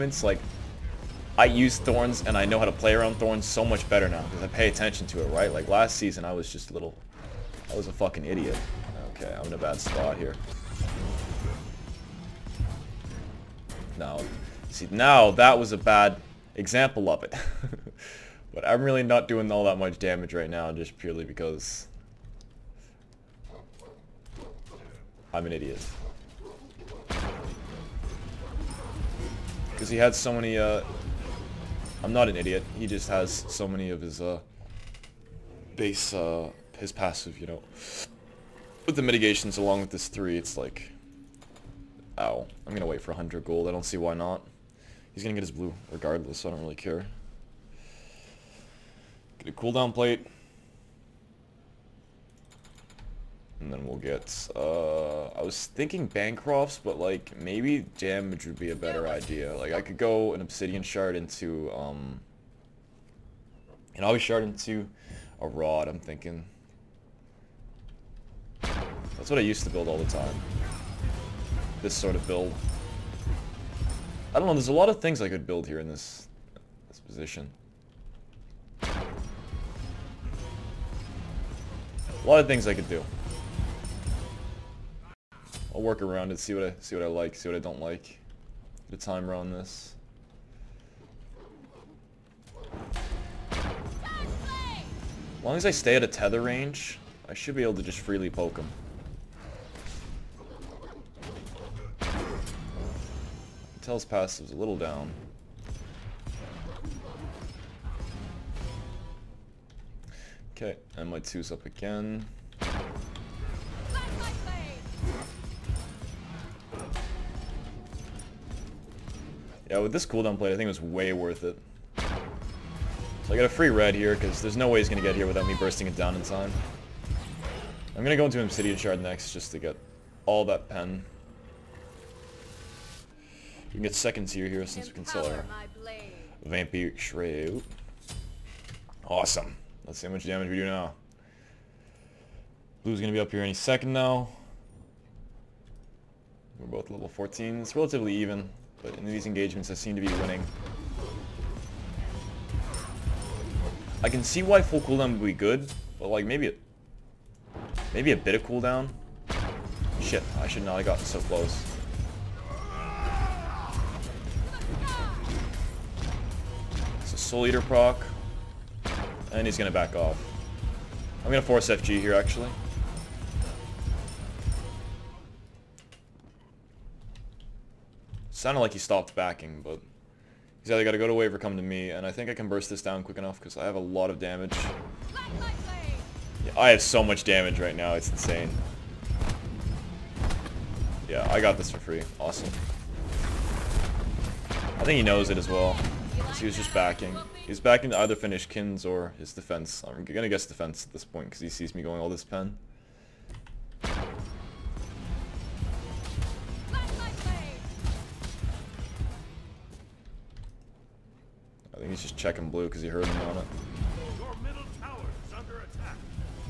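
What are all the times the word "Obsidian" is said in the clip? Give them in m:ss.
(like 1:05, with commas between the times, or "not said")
1:00, 2:08.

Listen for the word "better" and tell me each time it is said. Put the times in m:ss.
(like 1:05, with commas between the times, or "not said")
0:03, 0:58.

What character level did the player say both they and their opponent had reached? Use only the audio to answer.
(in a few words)
14.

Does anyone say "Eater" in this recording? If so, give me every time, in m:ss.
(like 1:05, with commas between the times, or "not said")
2:47.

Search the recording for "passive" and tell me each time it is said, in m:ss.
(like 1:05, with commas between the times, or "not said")
0:36, 1:44.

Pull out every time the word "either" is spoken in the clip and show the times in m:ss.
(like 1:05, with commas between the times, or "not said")
3:00, 3:18.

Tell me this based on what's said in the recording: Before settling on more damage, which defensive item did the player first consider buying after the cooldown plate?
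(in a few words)
Bancrofts.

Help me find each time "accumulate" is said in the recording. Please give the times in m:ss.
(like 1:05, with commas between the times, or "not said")
not said.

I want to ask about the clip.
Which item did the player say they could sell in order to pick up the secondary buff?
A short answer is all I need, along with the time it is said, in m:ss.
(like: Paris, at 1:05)
Vampire Shred, at 2:16.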